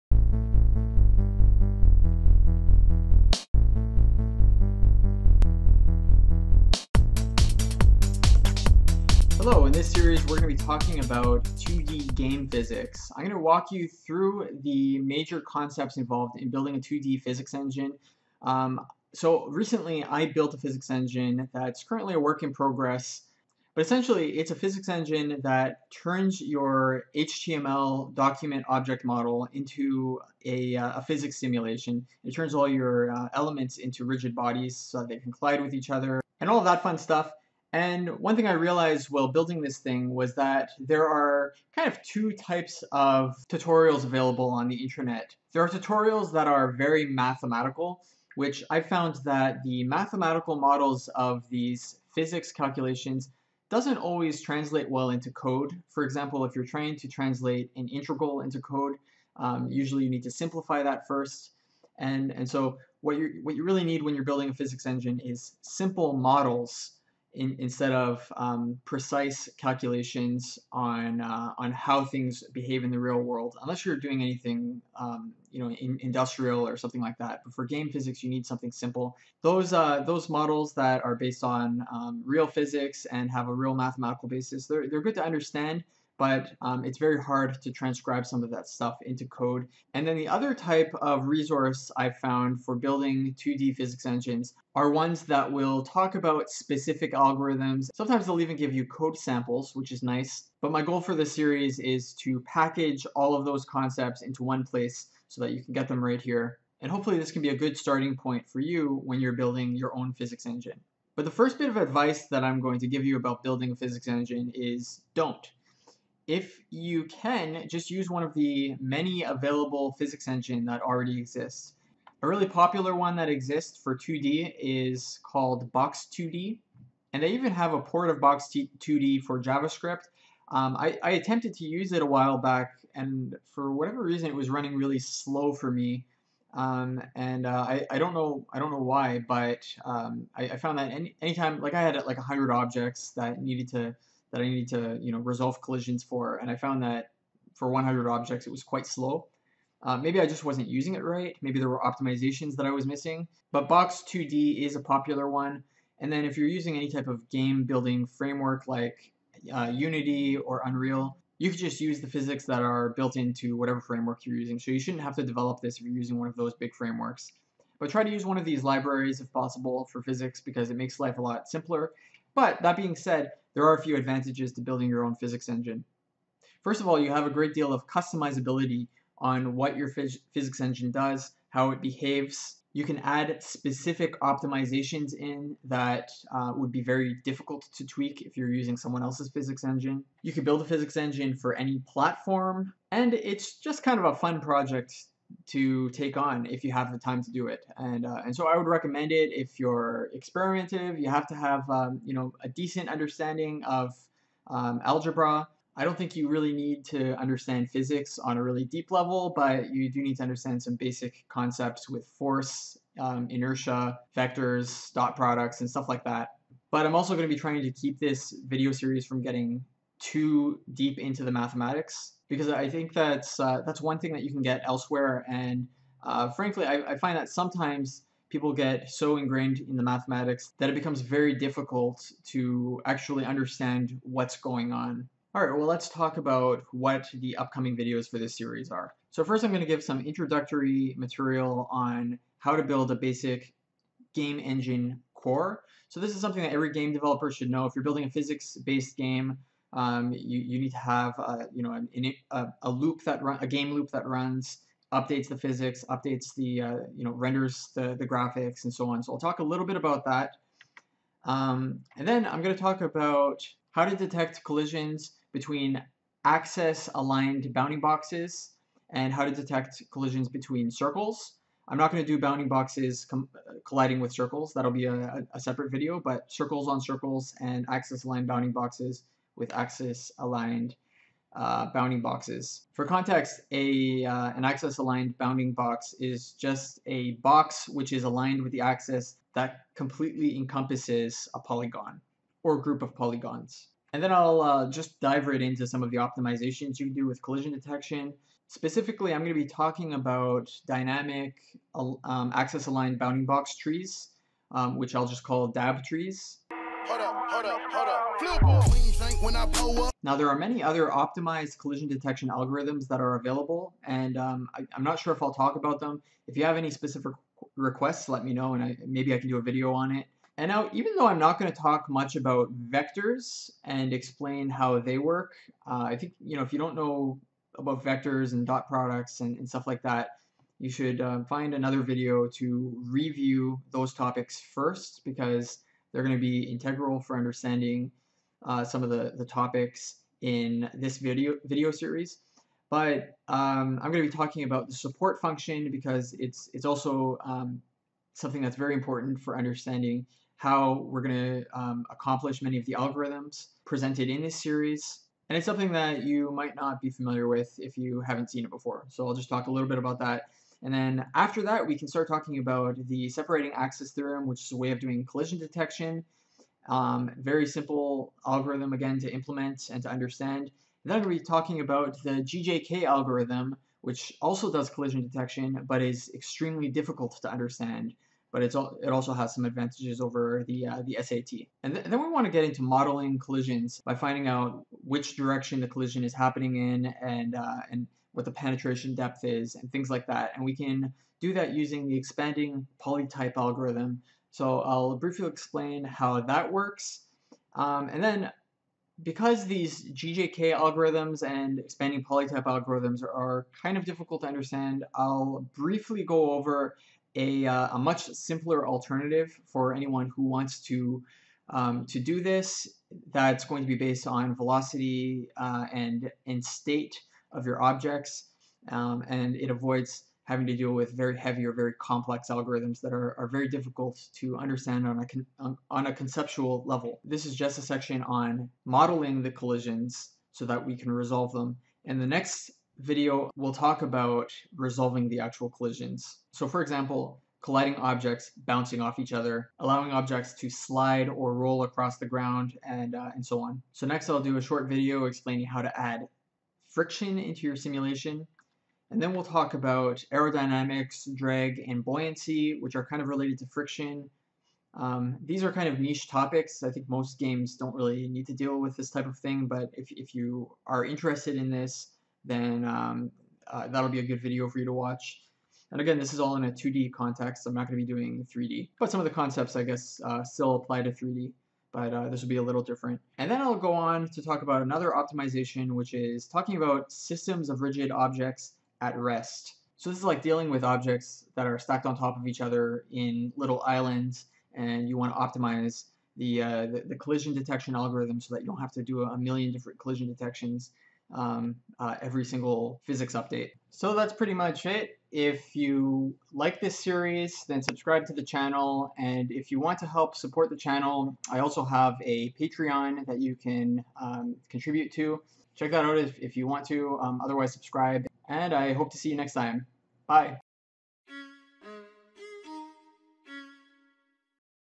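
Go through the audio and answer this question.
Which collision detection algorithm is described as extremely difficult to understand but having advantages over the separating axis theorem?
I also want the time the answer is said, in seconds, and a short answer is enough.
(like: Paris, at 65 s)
GJK algorithm, at 372 s.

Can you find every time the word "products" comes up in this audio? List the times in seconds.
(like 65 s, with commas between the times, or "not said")
215 s, 328 s.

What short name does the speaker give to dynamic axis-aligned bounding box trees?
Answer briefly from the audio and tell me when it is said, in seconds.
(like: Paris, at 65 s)
DAB trees, at 305 s.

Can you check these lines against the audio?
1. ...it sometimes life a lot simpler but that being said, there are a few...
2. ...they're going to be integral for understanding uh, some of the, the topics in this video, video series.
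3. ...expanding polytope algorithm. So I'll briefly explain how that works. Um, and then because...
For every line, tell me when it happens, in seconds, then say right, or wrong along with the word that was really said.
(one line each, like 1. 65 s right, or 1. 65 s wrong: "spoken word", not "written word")
1. 170 s wrong: "makes", not "sometimes"
2. 335 s right
3. 391 s right.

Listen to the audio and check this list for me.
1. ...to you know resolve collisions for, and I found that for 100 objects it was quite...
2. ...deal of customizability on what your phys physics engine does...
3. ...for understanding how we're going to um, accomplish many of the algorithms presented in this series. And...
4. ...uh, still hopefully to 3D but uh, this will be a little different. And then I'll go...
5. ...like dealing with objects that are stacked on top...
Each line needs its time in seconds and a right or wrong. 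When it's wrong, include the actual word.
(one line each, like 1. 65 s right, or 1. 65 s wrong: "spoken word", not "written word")
1. 144 s right
2. 177 s right
3. 349 s right
4. 470 s wrong: "apply", not "hopefully"
5. 480 s right.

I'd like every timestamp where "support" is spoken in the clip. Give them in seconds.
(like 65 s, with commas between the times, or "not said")
344 s, 500 s.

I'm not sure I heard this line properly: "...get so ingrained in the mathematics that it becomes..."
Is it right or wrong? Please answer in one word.
right.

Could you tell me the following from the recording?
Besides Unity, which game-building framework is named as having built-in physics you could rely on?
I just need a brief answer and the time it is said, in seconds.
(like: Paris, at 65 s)
Unreal, at 160 s.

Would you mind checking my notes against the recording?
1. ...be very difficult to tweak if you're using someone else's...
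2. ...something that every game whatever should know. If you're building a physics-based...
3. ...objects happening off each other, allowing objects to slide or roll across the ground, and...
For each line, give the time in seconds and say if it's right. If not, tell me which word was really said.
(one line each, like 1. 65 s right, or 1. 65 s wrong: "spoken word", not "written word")
1. 186 s right
2. 246 s wrong: "developer", not "whatever"
3. 437 s wrong: "bouncing", not "happening".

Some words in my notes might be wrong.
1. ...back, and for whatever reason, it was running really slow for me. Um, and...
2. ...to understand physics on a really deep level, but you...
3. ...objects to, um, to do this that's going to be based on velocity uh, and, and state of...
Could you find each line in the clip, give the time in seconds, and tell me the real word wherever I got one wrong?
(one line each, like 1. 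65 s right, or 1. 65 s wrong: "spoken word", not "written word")
1. 132 s right
2. 206 s right
3. 410 s wrong: "wants", not "objects".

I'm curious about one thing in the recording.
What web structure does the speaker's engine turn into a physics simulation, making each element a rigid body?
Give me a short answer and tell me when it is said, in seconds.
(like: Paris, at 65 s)
HTML document object model, at 27 s.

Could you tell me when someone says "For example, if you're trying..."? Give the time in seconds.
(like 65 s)
55 s.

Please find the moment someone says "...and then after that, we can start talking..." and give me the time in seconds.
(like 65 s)
360 s.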